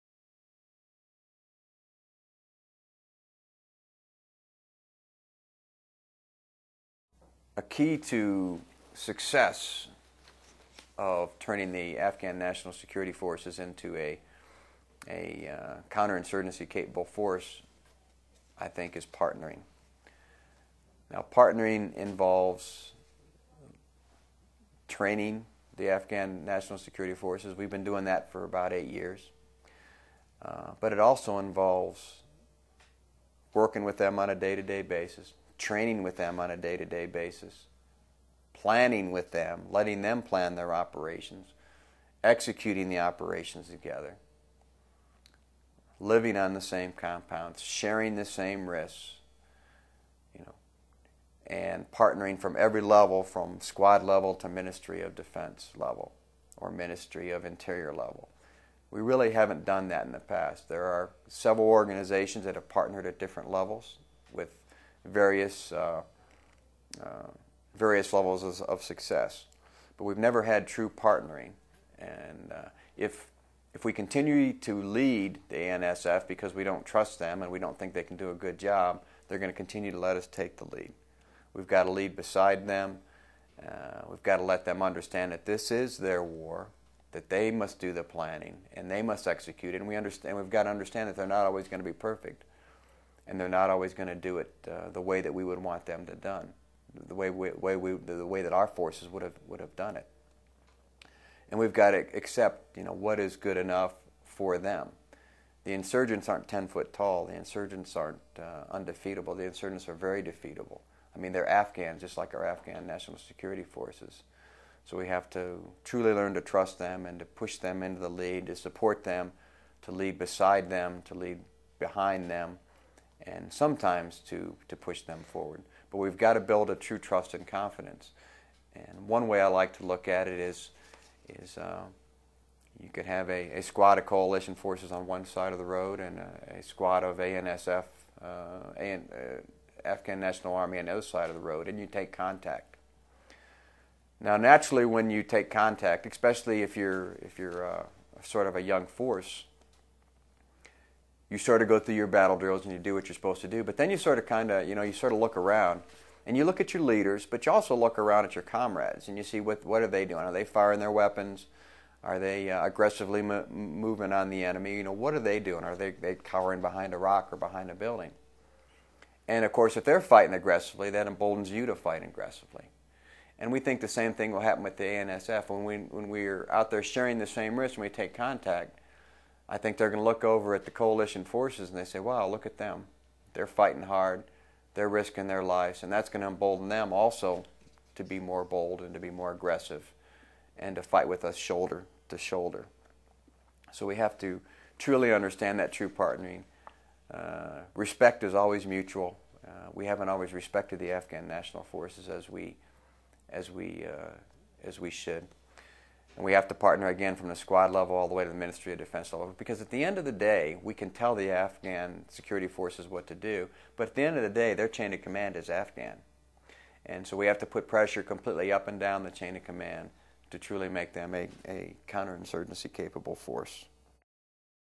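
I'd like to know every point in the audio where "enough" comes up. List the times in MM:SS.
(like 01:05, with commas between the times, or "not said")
01:43.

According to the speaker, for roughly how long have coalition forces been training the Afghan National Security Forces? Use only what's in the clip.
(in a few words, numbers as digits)
8 years.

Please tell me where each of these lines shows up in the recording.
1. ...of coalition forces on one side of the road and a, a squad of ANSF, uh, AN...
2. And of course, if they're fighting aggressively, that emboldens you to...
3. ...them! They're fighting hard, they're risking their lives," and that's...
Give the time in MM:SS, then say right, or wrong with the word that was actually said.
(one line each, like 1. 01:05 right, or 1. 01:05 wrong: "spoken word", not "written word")
1. 02:13 right
2. 02:49 right
3. 03:02 right.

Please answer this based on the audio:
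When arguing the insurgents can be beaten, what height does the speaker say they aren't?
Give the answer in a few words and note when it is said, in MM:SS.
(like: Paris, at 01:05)
10 foot tall, at 01:46.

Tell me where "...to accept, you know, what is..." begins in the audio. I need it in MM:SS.
01:41.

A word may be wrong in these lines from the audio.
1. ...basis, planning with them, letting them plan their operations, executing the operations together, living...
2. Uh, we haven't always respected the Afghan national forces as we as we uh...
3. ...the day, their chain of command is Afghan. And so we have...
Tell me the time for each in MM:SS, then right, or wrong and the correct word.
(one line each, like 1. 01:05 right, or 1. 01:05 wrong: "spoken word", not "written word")
1. 00:37 right
2. 03:19 right
3. 03:34 right.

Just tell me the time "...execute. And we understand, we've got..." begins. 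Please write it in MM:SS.
01:29.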